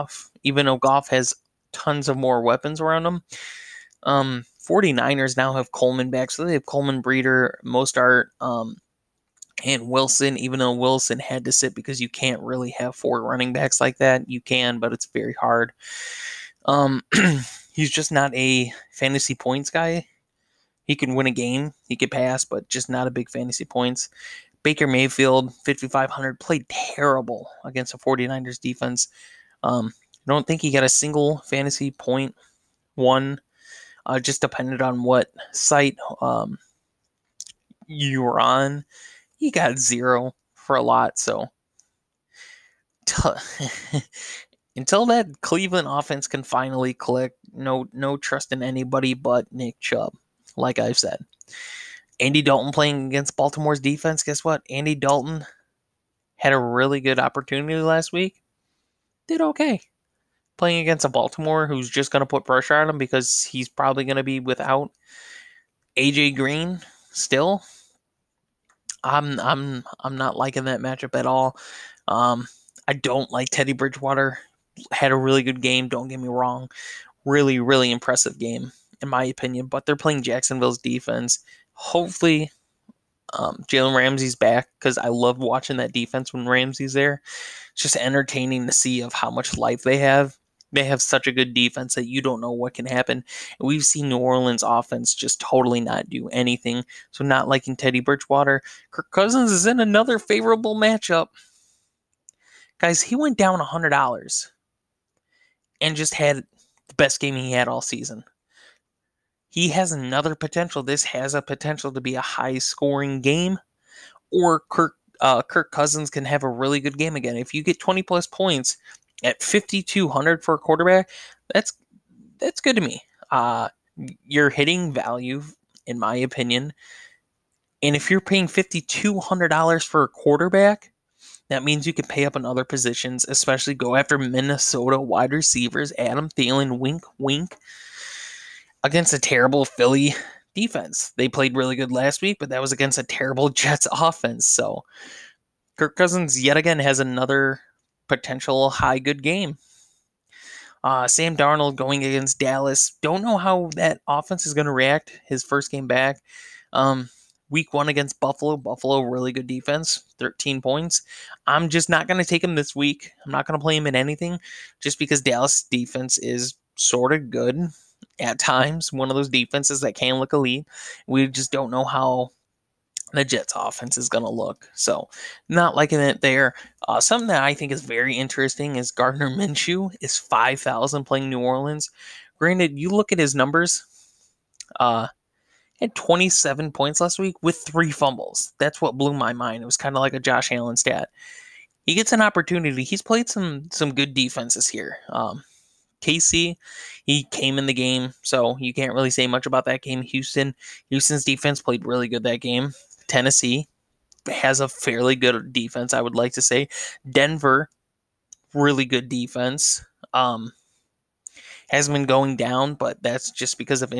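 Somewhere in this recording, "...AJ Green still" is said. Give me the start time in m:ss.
1:05.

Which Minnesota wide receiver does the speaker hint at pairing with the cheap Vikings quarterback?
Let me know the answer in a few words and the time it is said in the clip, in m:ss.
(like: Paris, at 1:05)
Adam Thielen, at 2:15.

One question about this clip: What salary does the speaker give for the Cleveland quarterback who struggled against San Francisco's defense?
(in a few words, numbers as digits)
5,500.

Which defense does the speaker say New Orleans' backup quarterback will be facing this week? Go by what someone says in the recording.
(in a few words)
Jacksonville.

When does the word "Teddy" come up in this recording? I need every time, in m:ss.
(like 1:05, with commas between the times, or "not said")
1:13, 1:37.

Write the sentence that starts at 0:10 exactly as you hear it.
Even though Wilson had to sit because you can't really have four running backs like that, you can, but it's very hard.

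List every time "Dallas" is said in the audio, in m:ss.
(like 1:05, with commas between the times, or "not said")
2:32, 2:45.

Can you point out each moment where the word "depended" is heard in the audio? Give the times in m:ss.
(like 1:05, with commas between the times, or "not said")
0:34.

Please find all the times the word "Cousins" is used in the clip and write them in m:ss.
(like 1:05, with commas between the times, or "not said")
1:39, 1:55, 2:25.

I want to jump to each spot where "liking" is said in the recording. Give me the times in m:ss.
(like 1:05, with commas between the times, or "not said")
1:10, 1:37, 2:55.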